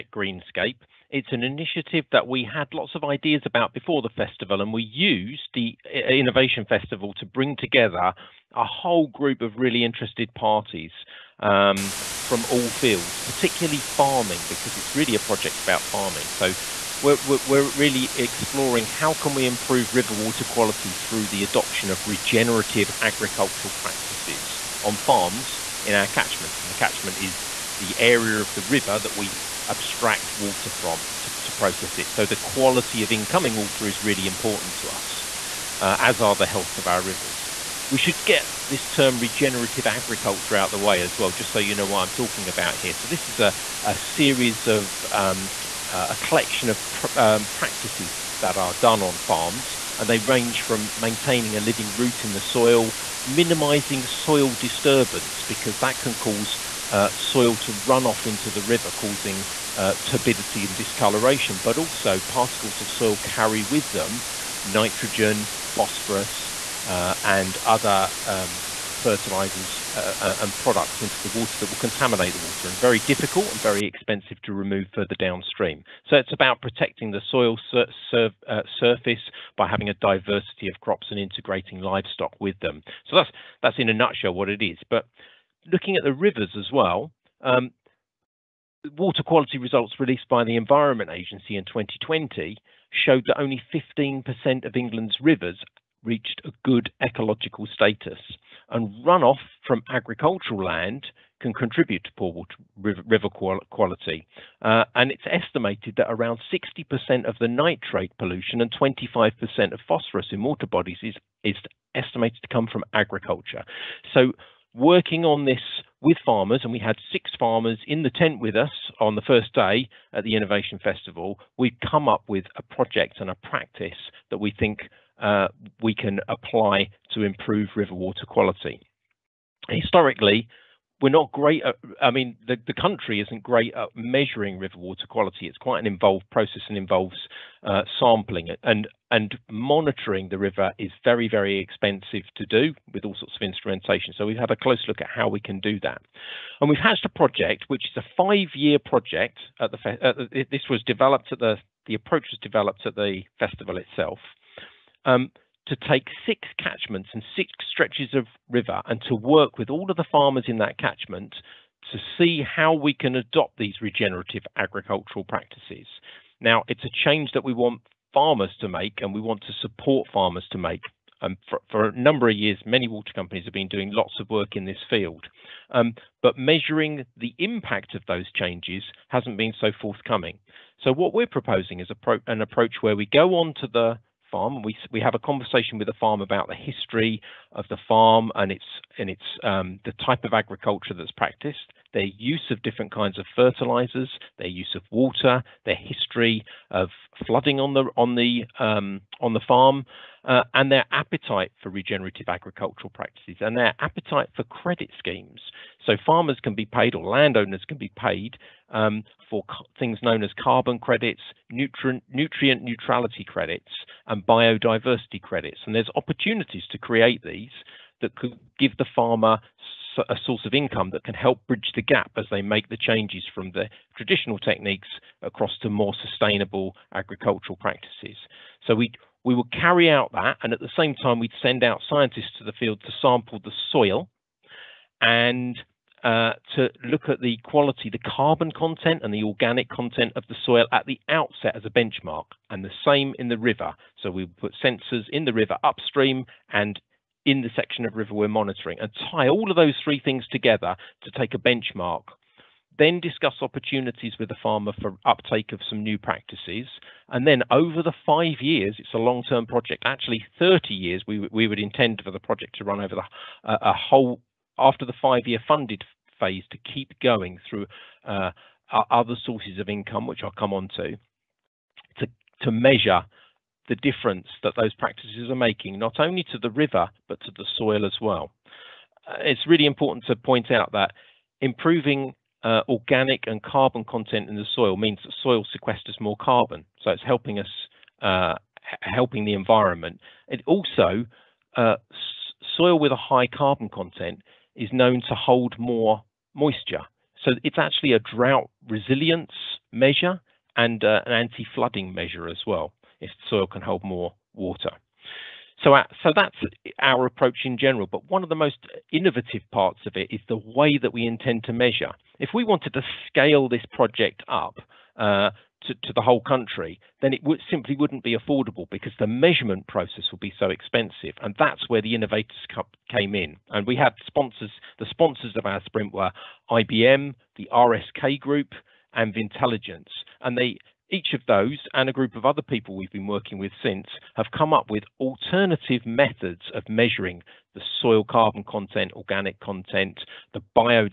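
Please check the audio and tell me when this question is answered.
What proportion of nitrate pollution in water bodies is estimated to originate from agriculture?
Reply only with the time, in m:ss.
1:46.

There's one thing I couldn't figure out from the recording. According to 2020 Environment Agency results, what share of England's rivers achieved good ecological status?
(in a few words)
15%.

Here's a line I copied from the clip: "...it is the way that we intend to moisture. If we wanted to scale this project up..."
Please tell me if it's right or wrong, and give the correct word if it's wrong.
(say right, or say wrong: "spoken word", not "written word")
wrong: "measure", not "moisture".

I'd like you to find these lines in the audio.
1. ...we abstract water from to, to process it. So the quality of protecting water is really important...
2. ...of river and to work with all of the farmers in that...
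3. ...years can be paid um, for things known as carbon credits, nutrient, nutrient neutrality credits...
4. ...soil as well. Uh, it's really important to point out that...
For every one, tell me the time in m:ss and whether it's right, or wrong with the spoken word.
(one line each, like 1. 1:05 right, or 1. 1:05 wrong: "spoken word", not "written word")
1. 0:29 wrong: "incoming", not "protecting"
2. 2:38 right
3. 3:27 wrong: "landowners", not "years"
4. 4:37 right.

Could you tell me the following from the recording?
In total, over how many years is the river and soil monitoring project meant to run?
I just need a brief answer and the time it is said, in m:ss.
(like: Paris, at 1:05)
30 years, at 4:20.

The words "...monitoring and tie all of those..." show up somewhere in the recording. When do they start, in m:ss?
4:08.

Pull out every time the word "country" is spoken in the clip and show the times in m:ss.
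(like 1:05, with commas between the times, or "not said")
2:12, 5:16.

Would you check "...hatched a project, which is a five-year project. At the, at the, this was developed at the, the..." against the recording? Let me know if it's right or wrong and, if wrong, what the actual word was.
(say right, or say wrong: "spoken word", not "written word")
right.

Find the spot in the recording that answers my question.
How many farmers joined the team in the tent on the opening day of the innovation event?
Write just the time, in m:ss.
1:57.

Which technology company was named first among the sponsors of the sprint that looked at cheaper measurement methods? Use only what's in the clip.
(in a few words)
IBM.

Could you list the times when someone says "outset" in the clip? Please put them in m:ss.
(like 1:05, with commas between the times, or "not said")
4:01.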